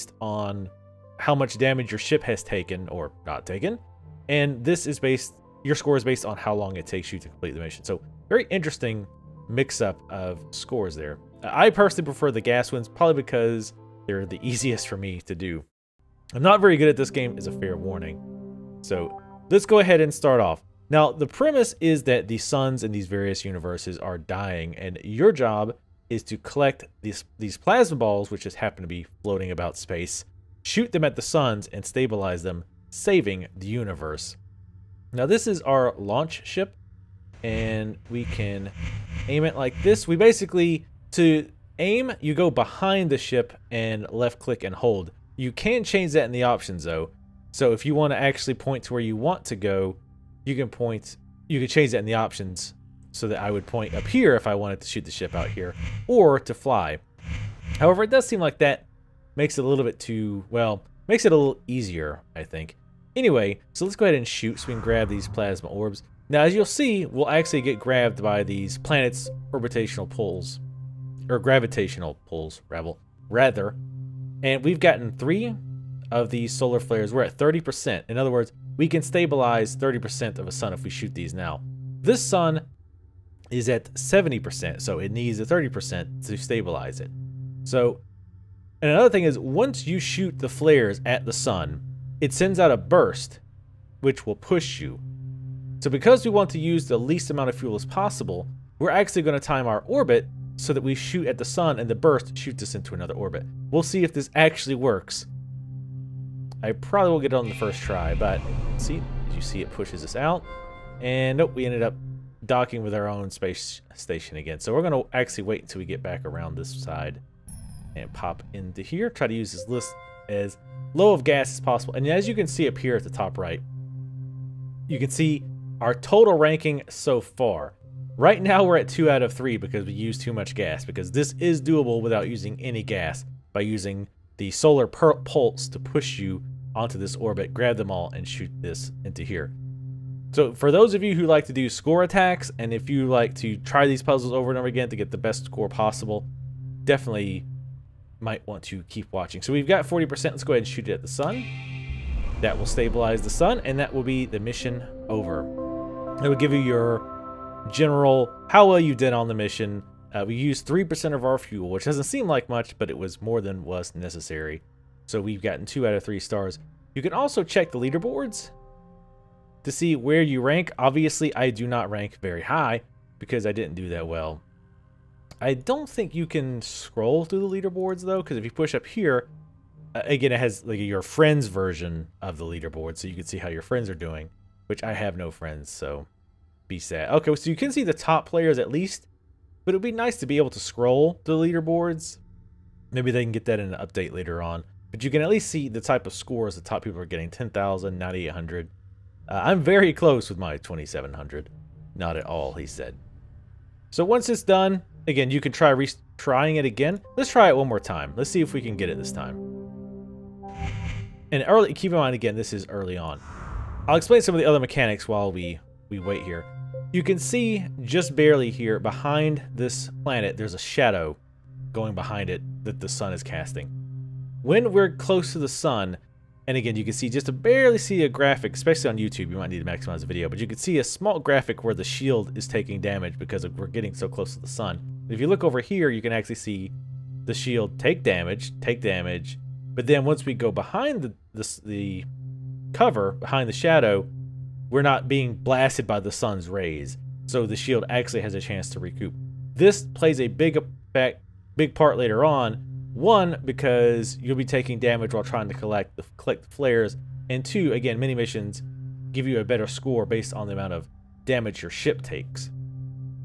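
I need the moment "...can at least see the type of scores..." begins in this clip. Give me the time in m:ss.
3:15.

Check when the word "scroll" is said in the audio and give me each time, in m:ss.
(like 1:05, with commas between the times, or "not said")
2:56, 3:10.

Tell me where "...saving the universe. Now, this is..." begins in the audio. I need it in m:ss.
0:32.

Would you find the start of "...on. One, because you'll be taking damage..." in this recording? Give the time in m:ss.
4:12.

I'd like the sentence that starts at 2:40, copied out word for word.
Uh, we used 3% of our fuel, which doesn't seem like much, but it was more than was necessary.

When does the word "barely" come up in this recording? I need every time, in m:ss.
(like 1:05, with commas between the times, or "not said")
3:38, 3:47.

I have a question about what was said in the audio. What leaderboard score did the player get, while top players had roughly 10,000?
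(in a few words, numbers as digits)
2,700.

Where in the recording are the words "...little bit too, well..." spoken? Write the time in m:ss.
0:59.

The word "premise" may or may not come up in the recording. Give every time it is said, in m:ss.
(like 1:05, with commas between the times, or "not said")
0:21.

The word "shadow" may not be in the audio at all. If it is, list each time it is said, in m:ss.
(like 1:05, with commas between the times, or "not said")
3:40, 4:03.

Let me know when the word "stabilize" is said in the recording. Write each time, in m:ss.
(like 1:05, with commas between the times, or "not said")
0:31, 1:19, 1:26, 2:32.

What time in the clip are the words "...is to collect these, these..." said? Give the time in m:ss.
0:26.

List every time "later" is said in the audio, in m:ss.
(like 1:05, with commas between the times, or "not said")
3:14, 4:11.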